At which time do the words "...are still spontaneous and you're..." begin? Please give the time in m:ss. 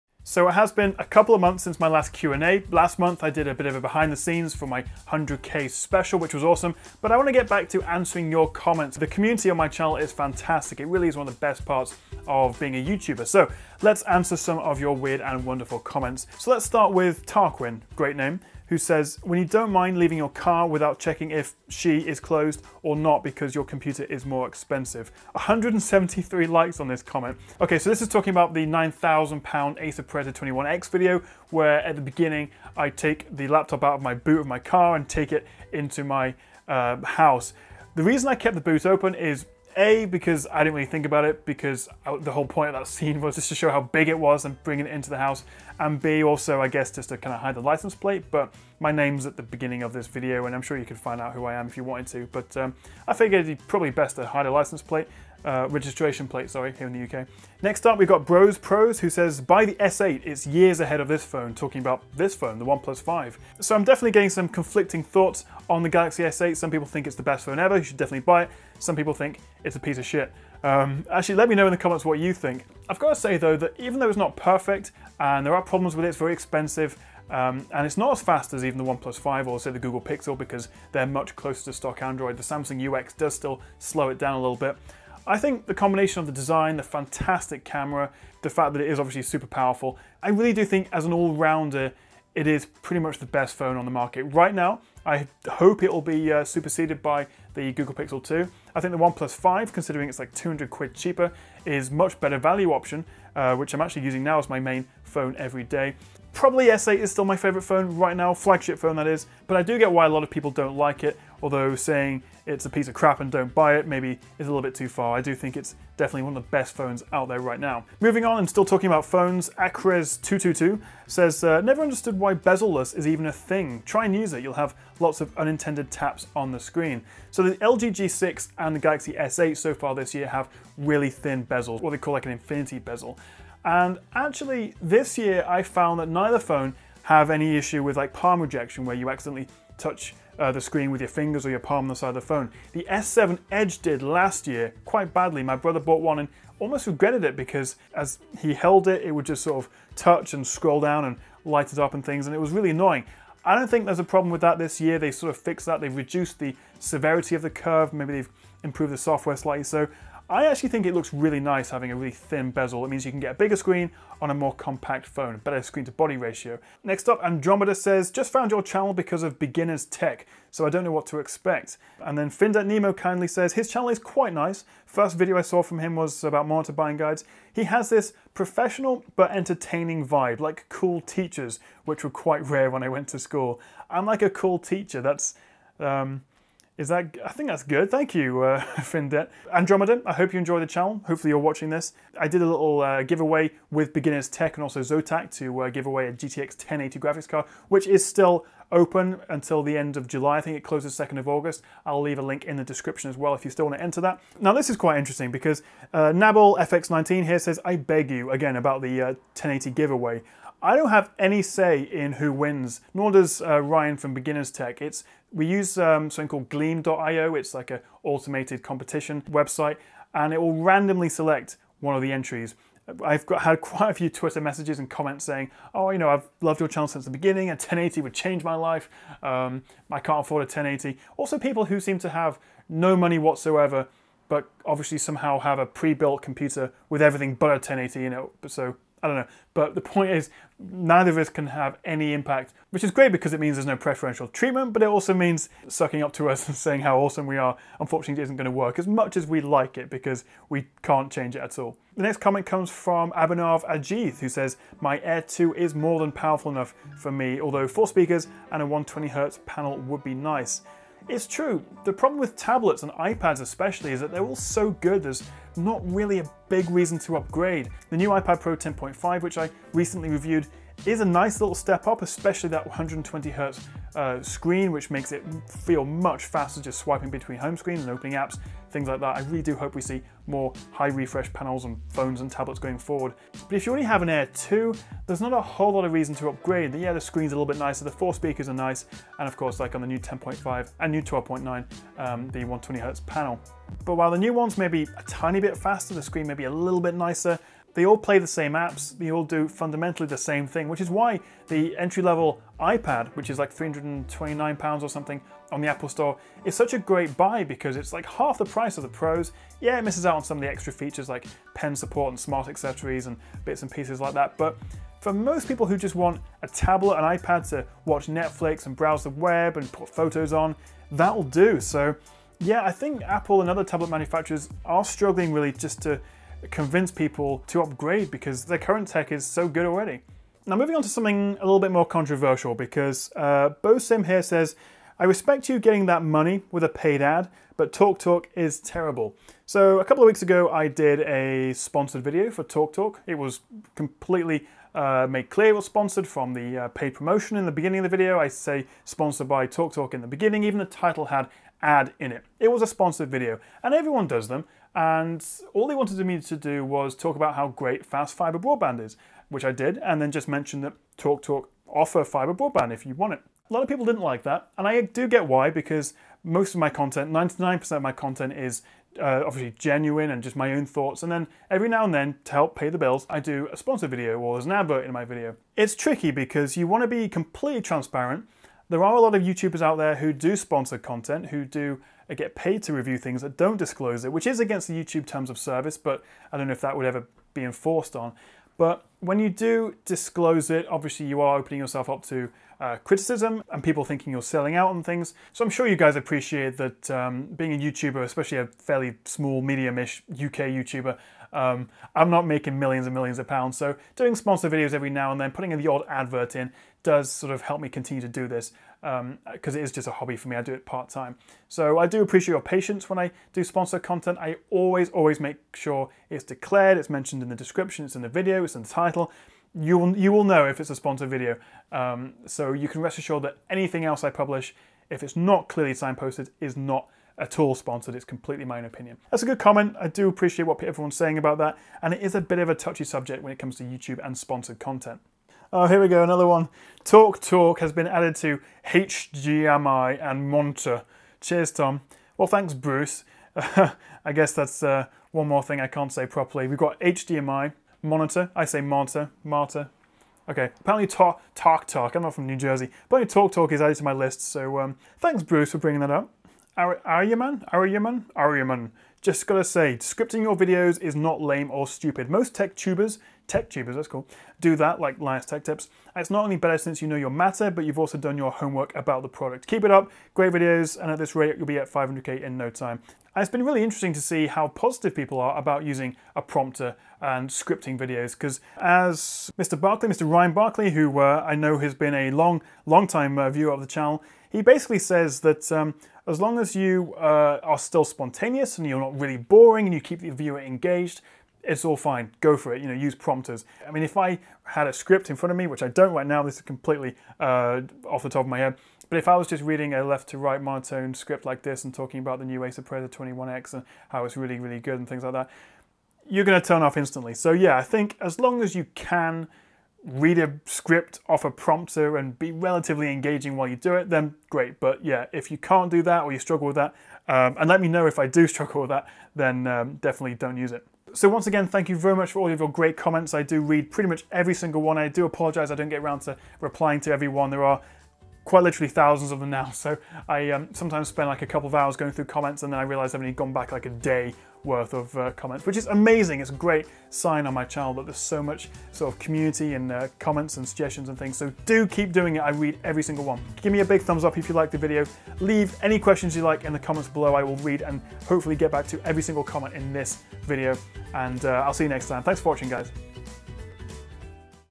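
8:07.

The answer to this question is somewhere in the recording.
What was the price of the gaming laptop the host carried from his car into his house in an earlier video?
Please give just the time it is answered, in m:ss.
0:28.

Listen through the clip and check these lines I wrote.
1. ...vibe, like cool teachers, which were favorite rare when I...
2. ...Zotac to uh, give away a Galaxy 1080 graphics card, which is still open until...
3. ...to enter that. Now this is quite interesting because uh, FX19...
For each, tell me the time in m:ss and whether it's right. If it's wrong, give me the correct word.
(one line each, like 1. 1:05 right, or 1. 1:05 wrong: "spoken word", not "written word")
1. 3:00 wrong: "quite", not "favorite"
2. 3:14 wrong: "GTX", not "Galaxy"
3. 3:23 right.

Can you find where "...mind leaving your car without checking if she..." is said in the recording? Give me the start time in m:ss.
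0:19.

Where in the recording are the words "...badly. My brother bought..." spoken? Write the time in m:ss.
2:25.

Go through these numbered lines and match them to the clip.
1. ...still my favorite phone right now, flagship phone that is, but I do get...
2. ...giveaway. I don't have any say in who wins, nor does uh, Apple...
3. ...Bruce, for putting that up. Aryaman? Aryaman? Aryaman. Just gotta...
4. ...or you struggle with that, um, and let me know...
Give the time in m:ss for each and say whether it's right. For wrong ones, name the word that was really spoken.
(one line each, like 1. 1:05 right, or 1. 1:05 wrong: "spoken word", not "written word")
1. 1:47 right
2. 3:29 wrong: "Ryan", not "Apple"
3. 7:35 wrong: "bringing", not "putting"
4. 8:36 right.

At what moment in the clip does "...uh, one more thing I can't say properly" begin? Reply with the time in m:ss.
7:24.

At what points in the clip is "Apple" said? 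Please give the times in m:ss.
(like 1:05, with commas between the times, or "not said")
5:05, 5:23.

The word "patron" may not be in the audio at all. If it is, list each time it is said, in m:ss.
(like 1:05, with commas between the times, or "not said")
not said.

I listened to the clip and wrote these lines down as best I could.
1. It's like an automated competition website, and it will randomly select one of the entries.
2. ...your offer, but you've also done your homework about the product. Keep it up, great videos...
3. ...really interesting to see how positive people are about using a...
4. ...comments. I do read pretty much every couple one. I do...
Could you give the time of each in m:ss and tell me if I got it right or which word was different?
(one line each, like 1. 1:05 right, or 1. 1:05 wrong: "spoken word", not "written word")
1. 3:37 right
2. 7:46 wrong: "matter", not "offer"
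3. 7:53 right
4. 8:42 wrong: "single", not "couple".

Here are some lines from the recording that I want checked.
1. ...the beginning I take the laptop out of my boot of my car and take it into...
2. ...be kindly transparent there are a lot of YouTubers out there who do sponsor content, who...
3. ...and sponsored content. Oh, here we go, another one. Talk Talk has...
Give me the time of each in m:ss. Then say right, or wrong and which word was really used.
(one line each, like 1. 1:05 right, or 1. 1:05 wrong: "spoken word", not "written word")
1. 0:31 right
2. 6:16 wrong: "completely", not "kindly"
3. 7:14 right.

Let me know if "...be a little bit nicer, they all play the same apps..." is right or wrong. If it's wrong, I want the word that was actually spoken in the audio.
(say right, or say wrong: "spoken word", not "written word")
right.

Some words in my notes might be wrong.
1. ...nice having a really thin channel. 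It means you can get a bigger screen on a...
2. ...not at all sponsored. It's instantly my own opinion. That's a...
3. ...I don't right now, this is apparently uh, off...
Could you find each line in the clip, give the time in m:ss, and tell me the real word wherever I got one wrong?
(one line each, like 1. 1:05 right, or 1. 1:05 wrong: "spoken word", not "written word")
1. 2:41 wrong: "bezel", not "channel"
2. 7:06 wrong: "completely", not "instantly"
3. 8:15 wrong: "completely", not "apparently".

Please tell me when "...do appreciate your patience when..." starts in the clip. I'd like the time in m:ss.
6:51.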